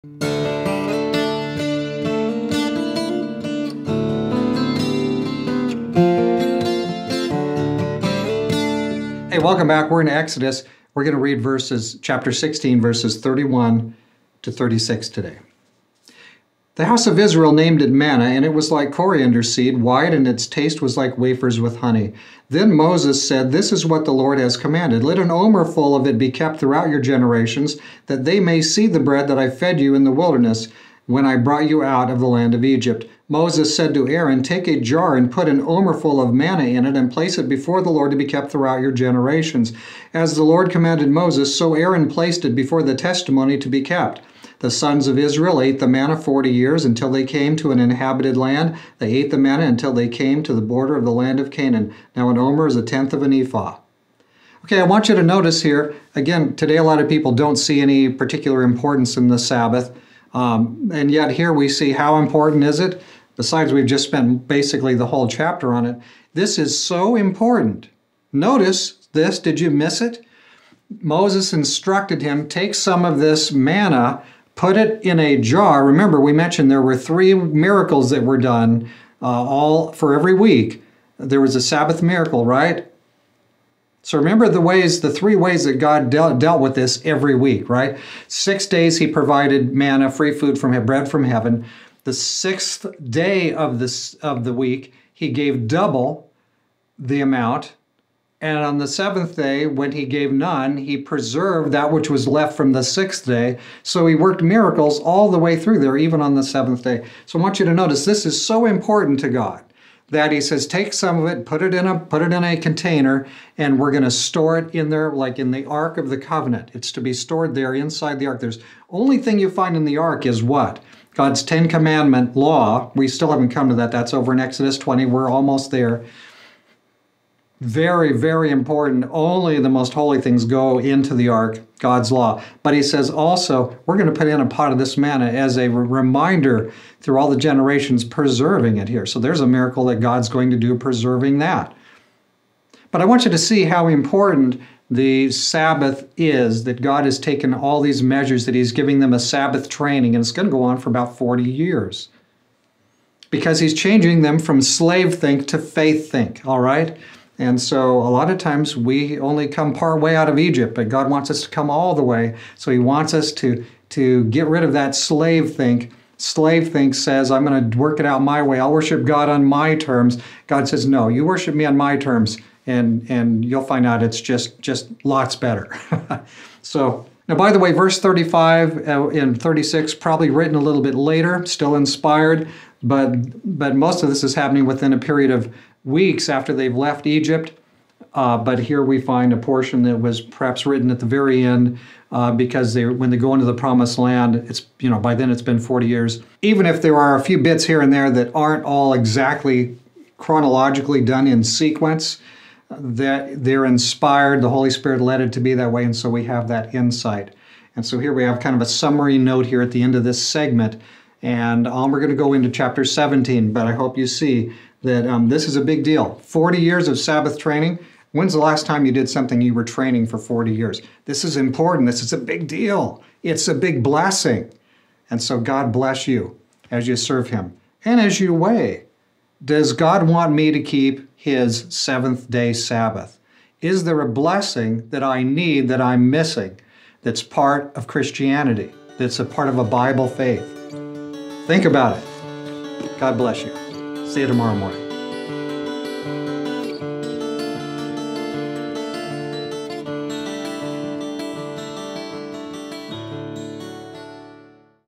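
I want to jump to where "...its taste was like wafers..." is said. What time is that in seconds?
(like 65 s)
20 s.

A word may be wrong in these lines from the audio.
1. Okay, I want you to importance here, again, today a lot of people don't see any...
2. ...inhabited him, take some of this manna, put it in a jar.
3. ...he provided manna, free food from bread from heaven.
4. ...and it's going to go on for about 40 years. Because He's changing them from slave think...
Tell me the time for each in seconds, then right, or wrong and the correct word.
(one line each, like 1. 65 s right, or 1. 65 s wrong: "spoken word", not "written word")
1. 54 s wrong: "notice", not "importance"
2. 71 s wrong: "instructed", not "inhabited"
3. 88 s right
4. 150 s right.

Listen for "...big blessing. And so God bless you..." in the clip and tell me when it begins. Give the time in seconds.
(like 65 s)
223 s.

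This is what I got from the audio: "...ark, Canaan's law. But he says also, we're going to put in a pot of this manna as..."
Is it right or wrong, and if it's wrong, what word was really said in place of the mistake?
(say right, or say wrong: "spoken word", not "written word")
wrong: "God", not "Canaan".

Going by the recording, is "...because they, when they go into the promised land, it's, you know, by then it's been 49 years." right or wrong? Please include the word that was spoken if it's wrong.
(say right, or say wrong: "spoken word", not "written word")
wrong: "40", not "49".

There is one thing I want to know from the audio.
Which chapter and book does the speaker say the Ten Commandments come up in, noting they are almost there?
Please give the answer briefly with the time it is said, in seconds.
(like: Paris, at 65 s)
Exodus 20, at 124 s.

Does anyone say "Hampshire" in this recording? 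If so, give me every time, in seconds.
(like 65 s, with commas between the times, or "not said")
not said.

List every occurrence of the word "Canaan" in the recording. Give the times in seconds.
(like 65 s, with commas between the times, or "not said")
51 s.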